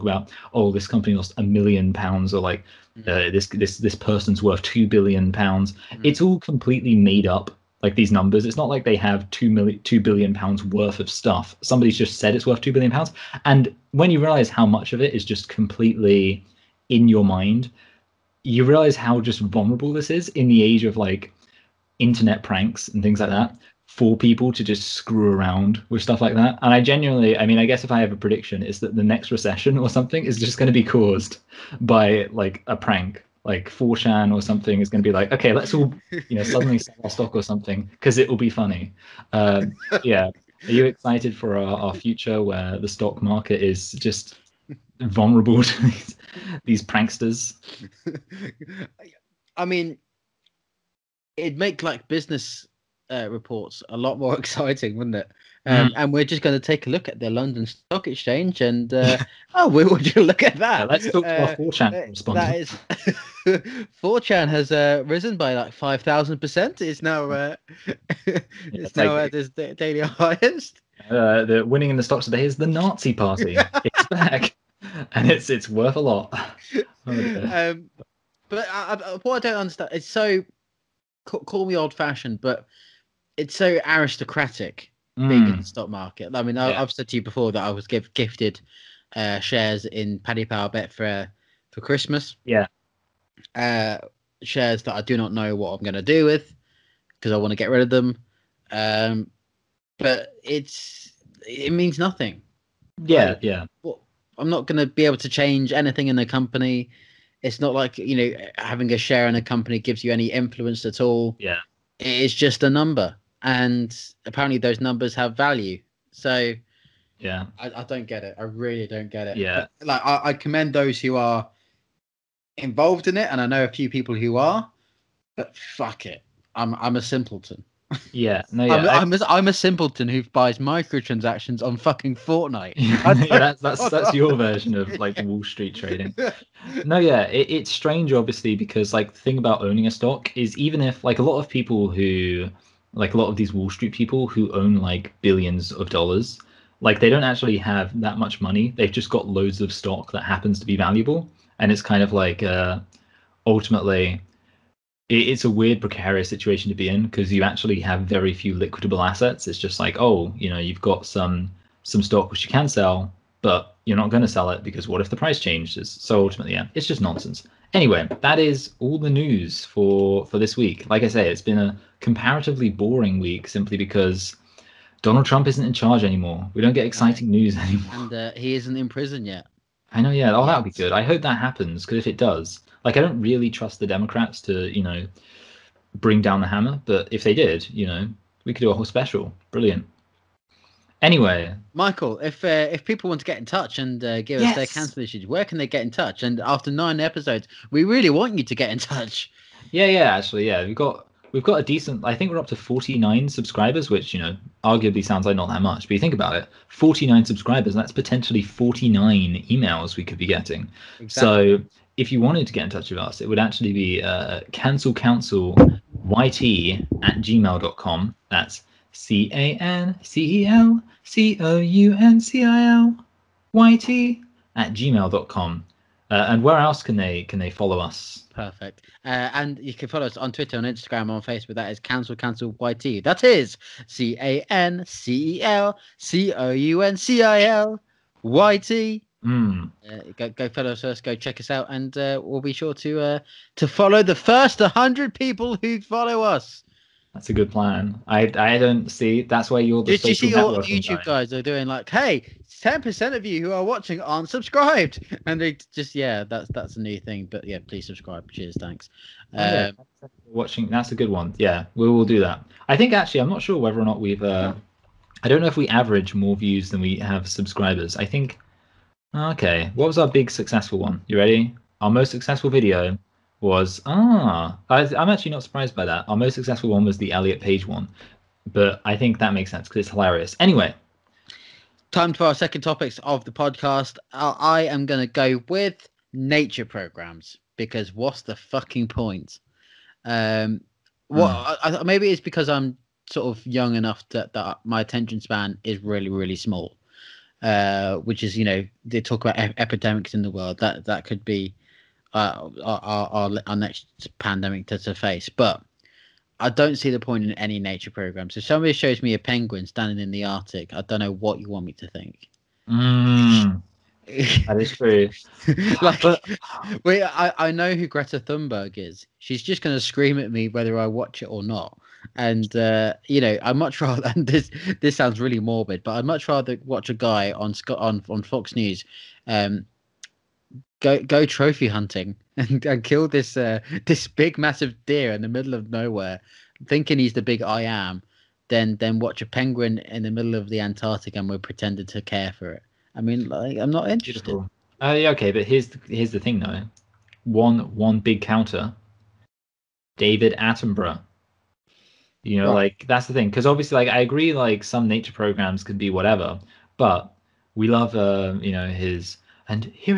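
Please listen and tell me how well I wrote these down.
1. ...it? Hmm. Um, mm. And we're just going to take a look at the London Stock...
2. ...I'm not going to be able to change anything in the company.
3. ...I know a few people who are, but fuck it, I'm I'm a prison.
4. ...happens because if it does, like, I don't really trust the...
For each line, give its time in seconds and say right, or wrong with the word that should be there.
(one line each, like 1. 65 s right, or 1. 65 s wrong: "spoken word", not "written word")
1. 55 s right
2. 104 s right
3. 123 s wrong: "simpleton", not "prison"
4. 181 s right.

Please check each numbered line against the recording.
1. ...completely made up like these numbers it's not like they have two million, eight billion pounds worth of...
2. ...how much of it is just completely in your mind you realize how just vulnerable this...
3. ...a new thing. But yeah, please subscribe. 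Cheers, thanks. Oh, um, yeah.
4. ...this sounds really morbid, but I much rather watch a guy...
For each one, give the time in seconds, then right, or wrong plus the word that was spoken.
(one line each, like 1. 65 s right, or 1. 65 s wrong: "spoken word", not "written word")
1. 6 s wrong: "two", not "eight"
2. 14 s right
3. 256 s right
4. 324 s right.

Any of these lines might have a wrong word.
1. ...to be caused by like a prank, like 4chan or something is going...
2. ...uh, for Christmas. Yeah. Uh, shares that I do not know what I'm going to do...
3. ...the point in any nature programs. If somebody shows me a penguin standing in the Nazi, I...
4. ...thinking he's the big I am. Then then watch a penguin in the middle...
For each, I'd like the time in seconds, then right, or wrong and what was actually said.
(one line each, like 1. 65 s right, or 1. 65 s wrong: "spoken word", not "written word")
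1. 30 s right
2. 91 s right
3. 306 s wrong: "Arctic", not "Nazi"
4. 336 s right.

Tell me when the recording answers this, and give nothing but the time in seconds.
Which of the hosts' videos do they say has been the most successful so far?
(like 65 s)
277 s.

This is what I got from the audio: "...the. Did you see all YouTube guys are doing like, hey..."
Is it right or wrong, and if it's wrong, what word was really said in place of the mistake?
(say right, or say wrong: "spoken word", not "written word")
right.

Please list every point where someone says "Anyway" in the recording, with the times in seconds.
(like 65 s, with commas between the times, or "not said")
167 s, 191 s, 280 s.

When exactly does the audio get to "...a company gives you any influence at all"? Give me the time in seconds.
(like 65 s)
109 s.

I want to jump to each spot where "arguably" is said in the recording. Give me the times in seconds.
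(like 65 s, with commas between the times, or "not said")
204 s.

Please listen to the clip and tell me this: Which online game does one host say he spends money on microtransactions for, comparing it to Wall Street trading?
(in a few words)
Fortnite.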